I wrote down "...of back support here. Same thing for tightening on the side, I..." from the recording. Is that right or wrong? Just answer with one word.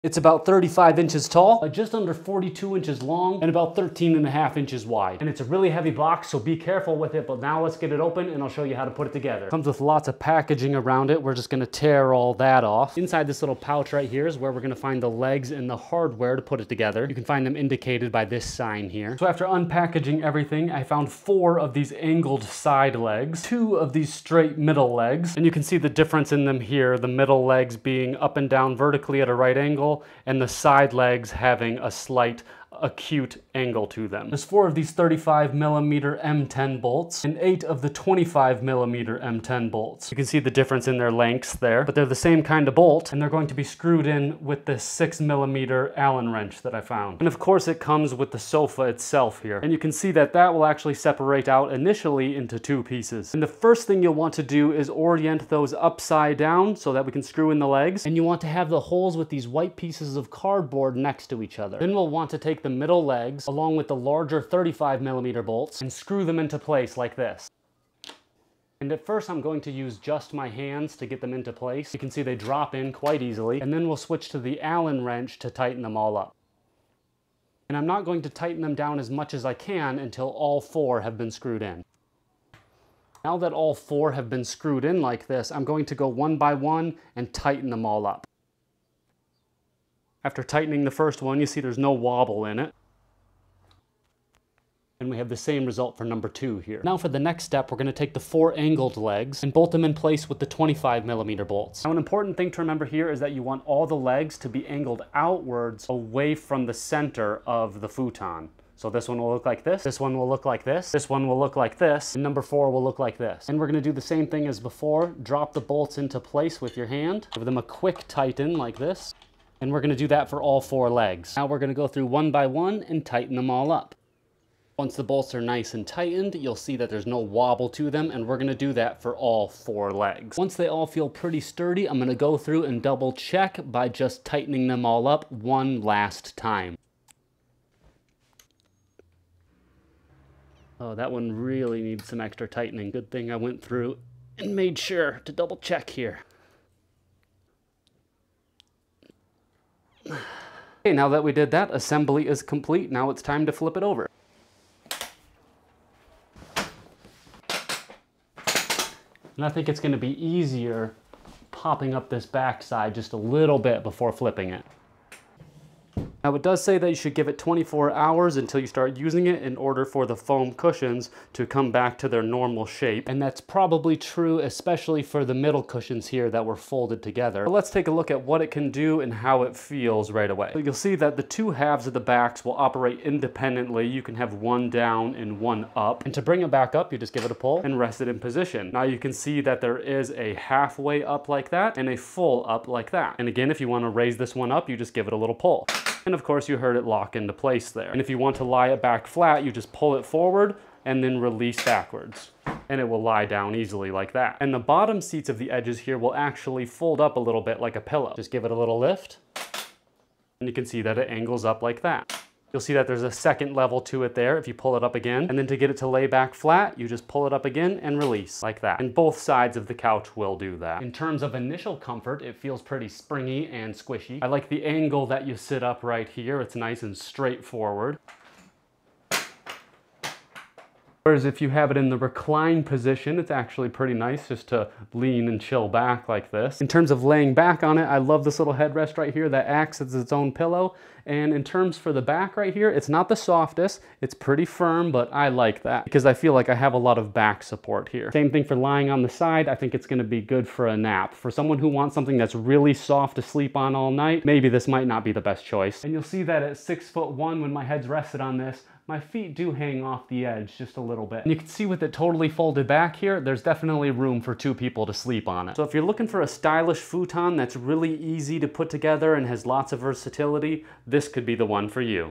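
wrong.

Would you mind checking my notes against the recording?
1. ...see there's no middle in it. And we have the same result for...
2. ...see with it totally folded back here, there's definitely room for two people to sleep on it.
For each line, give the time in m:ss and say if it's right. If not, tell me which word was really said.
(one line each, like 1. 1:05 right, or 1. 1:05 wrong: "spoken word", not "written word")
1. 1:31 wrong: "wobble", not "middle"
2. 4:21 right.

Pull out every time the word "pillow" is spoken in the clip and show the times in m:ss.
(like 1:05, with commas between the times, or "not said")
3:27, 4:00.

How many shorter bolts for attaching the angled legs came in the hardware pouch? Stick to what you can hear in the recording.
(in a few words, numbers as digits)
8.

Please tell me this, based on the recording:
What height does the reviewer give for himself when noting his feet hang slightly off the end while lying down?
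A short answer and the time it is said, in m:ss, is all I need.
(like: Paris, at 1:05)
6 foot 1, at 4:16.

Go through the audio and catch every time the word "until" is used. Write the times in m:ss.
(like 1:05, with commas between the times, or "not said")
1:19, 2:48.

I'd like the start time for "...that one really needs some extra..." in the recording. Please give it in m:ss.
2:20.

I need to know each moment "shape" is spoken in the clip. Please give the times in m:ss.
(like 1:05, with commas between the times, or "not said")
2:52.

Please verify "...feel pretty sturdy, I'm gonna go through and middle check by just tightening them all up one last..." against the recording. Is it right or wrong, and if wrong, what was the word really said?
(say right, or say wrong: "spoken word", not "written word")
wrong: "double", not "middle".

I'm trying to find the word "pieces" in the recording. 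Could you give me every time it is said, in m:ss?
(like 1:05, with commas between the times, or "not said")
0:52, 0:59.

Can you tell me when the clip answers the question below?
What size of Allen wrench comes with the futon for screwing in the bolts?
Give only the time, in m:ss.
0:44.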